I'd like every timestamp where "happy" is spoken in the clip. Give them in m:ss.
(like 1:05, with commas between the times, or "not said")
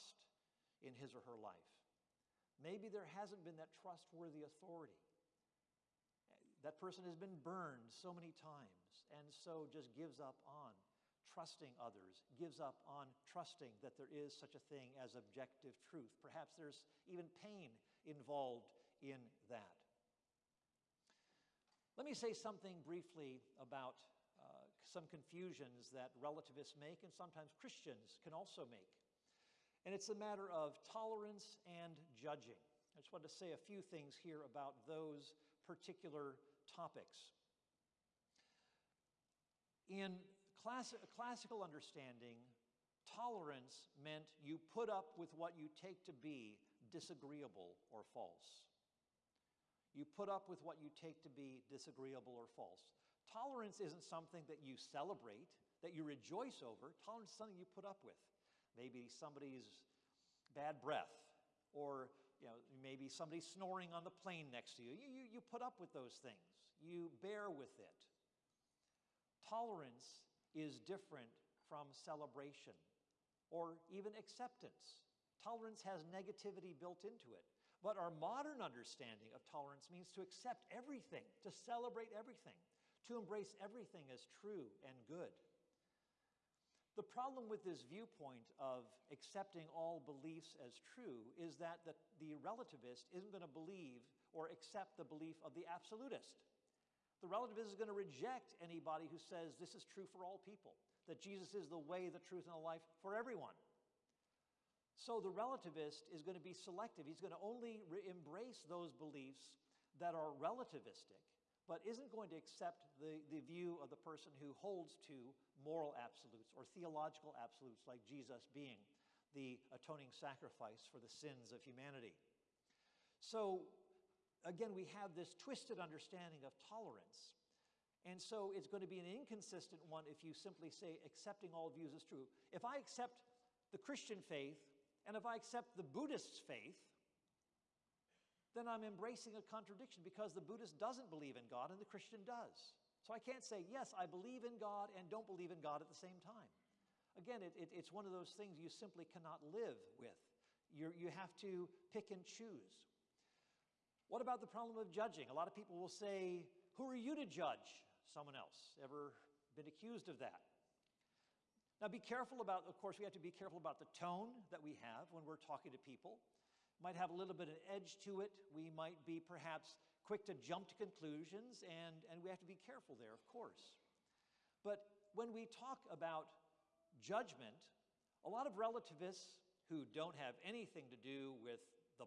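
not said.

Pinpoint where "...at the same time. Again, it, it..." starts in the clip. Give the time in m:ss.
2:25.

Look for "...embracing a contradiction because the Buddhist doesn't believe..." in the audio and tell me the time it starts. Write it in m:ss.
2:18.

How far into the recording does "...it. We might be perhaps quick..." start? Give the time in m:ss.
2:48.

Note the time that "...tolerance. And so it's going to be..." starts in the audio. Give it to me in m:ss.
2:06.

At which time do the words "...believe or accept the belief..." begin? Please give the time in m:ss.
1:33.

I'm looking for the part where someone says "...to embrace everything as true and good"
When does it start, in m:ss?
1:23.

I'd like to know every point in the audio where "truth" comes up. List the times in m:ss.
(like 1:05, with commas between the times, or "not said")
0:15, 1:42.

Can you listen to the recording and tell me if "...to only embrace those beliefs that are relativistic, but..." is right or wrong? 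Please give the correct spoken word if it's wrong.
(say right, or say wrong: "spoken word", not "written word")
right.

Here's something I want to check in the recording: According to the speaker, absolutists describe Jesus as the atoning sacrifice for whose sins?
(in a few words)
humanity.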